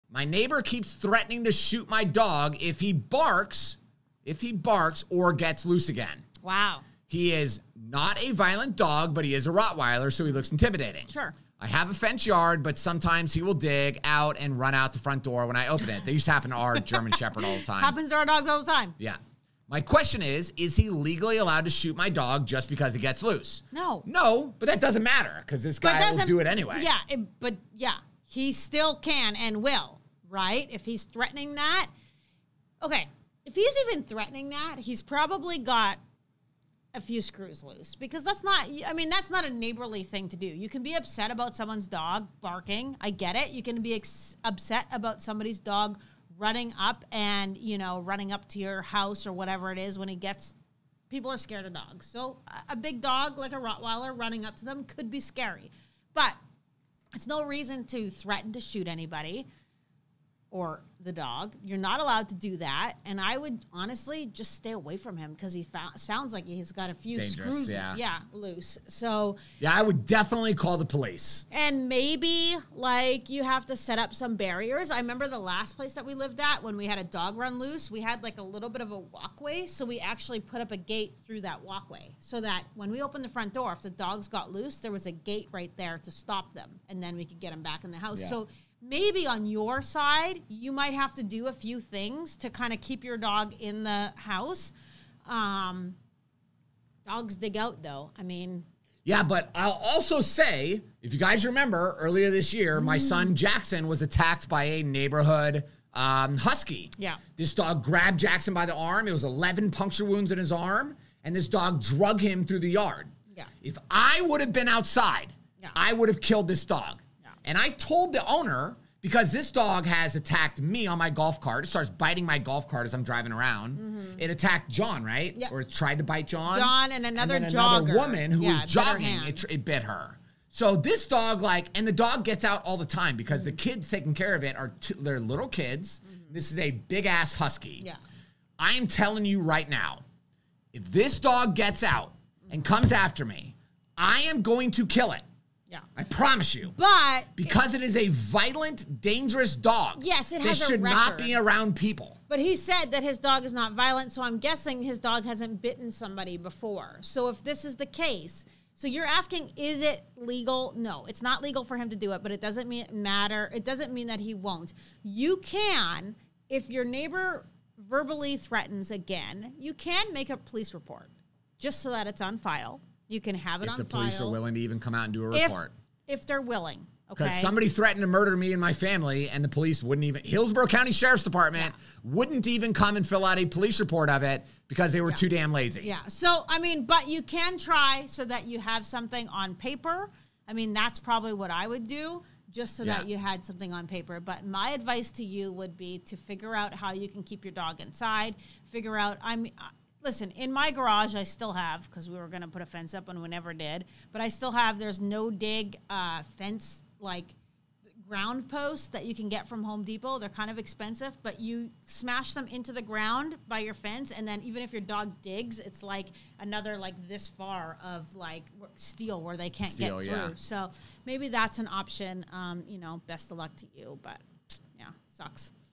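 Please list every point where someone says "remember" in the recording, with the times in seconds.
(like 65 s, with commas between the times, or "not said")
74 s, 101 s.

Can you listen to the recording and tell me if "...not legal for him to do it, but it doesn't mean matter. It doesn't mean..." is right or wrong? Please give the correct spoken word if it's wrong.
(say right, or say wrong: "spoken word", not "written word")
right.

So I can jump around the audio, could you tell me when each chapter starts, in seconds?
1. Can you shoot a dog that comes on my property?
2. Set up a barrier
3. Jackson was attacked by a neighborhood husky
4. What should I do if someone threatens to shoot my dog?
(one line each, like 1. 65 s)
1. 20 s
2. 72 s
3. 100 s
4. 170 s.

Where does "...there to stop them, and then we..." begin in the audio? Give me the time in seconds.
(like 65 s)
85 s.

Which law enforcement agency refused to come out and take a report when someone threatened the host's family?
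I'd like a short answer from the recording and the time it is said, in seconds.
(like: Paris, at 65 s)
Hillsborough County Sheriff's Department, at 180 s.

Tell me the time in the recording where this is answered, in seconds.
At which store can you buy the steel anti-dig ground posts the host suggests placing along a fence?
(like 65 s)
209 s.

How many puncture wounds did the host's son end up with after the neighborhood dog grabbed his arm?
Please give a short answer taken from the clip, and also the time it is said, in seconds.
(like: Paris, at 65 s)
11, at 109 s.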